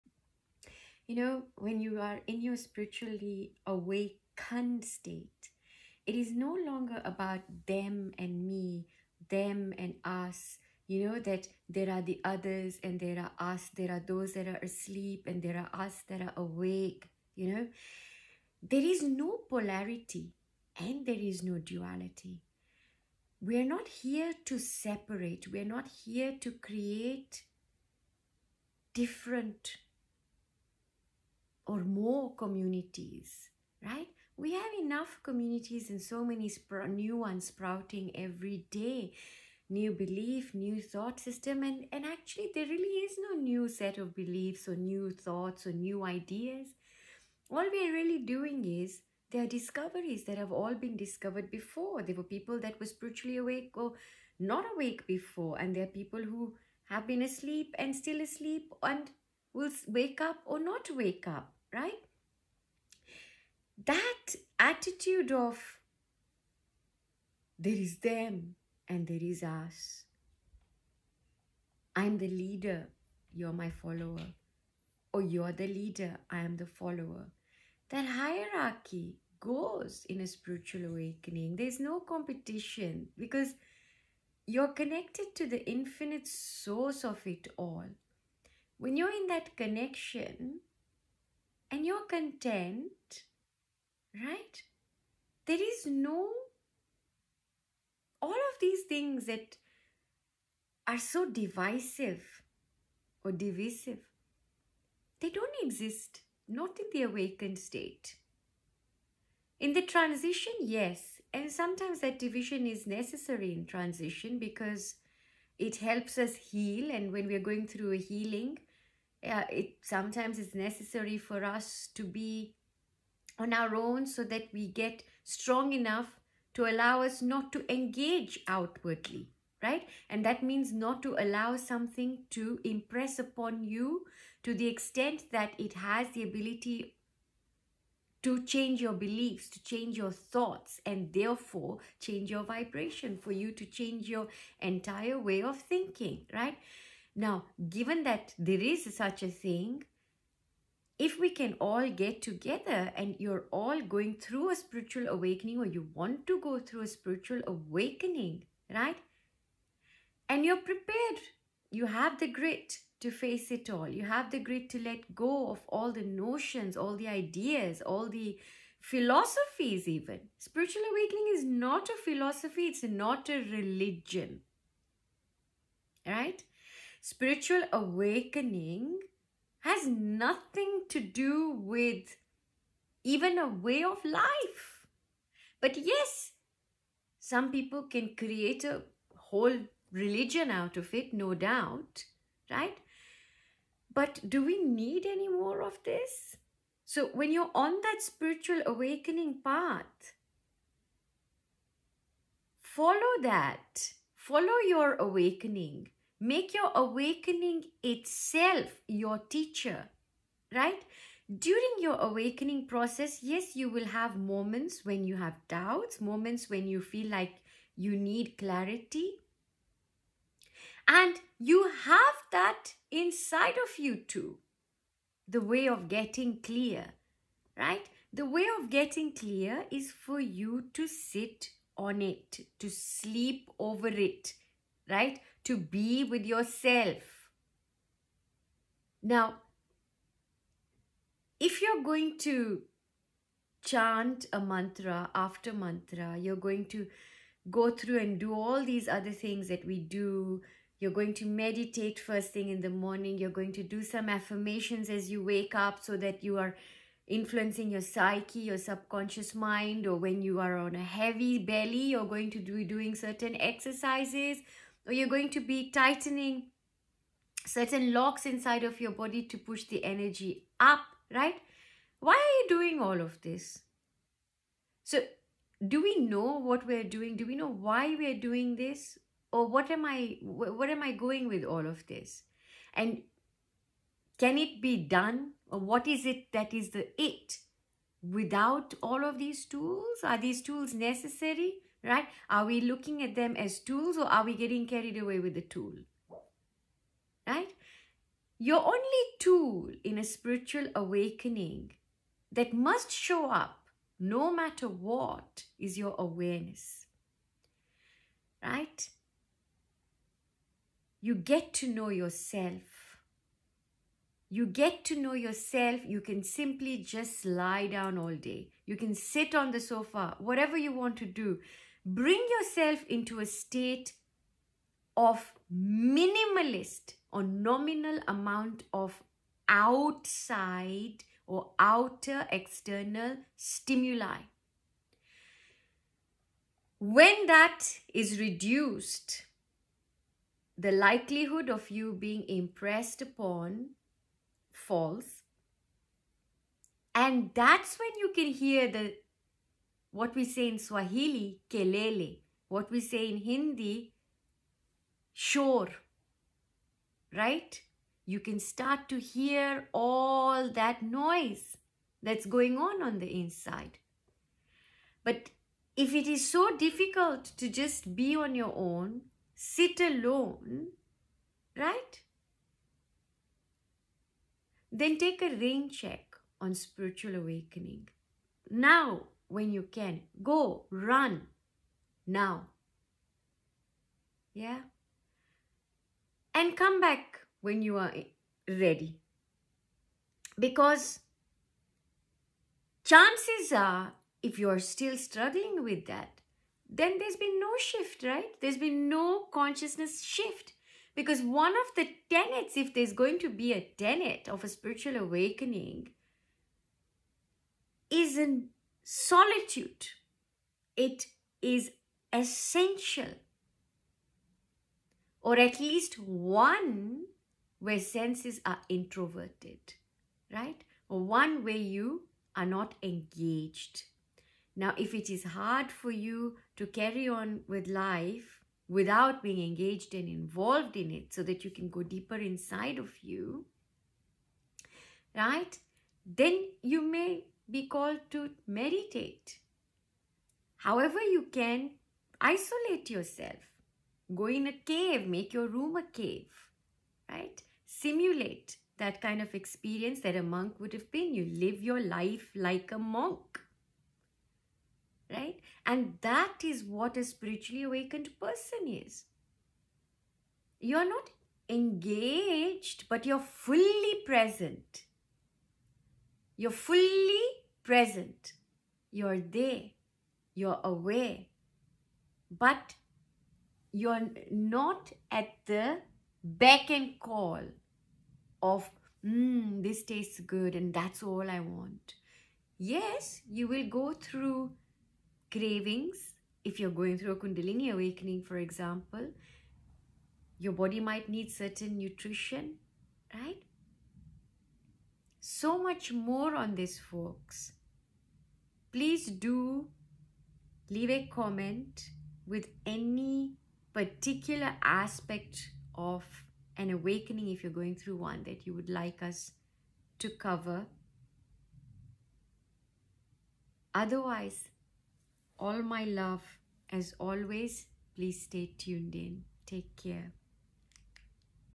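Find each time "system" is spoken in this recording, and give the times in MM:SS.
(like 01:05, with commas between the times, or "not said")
00:41.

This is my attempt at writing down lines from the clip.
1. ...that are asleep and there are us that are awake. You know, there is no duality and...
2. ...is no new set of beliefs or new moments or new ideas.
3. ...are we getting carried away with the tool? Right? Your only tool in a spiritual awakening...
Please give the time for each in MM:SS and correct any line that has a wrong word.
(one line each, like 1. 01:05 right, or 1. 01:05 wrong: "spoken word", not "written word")
1. 00:14 wrong: "polarity", not "duality"
2. 00:43 wrong: "thoughts", not "moments"
3. 04:54 right.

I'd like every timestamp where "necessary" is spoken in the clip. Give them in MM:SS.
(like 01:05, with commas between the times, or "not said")
01:52, 02:00, 04:50.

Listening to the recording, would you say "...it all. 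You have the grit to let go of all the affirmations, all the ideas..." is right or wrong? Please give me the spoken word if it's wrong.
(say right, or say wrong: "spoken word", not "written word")
wrong: "notions", not "affirmations".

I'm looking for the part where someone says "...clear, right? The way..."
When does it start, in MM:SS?
03:46.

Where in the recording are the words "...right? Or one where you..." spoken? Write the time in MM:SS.
07:00.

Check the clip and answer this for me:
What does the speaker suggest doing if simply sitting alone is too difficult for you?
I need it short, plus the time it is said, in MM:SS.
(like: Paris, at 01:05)
take a rain check, at 06:14.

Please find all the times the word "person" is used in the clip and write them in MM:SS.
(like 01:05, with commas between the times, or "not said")
07:38.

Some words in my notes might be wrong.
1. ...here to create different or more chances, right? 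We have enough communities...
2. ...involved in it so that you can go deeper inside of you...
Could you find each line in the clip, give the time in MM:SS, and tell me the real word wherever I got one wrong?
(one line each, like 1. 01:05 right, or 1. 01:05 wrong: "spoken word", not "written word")
1. 00:26 wrong: "communities", not "chances"
2. 07:10 right.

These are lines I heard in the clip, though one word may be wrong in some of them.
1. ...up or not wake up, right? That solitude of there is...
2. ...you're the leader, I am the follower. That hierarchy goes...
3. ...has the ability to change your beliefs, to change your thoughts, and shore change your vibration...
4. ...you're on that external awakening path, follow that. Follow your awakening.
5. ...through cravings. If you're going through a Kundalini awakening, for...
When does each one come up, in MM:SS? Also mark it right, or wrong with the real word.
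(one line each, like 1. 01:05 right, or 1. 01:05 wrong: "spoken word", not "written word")
1. 01:00 wrong: "attitude", not "solitude"
2. 01:15 right
3. 02:15 wrong: "therefore", not "shore"
4. 03:17 wrong: "spiritual", not "external"
5. 08:03 right.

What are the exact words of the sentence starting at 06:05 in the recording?
But if it is so difficult to just be on your own, sit alone, right?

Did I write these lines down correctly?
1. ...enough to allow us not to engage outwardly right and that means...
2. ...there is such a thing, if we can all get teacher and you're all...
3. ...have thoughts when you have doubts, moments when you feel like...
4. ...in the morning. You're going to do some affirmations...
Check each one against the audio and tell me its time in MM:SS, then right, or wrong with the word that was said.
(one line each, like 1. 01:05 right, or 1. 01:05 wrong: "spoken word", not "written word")
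1. 02:05 right
2. 02:28 wrong: "together", not "teacher"
3. 03:33 wrong: "moments", not "thoughts"
4. 04:12 right.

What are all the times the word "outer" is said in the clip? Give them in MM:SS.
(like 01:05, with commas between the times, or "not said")
05:31.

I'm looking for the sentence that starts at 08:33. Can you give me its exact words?
Otherwise, all my love as always, please stay tuned in.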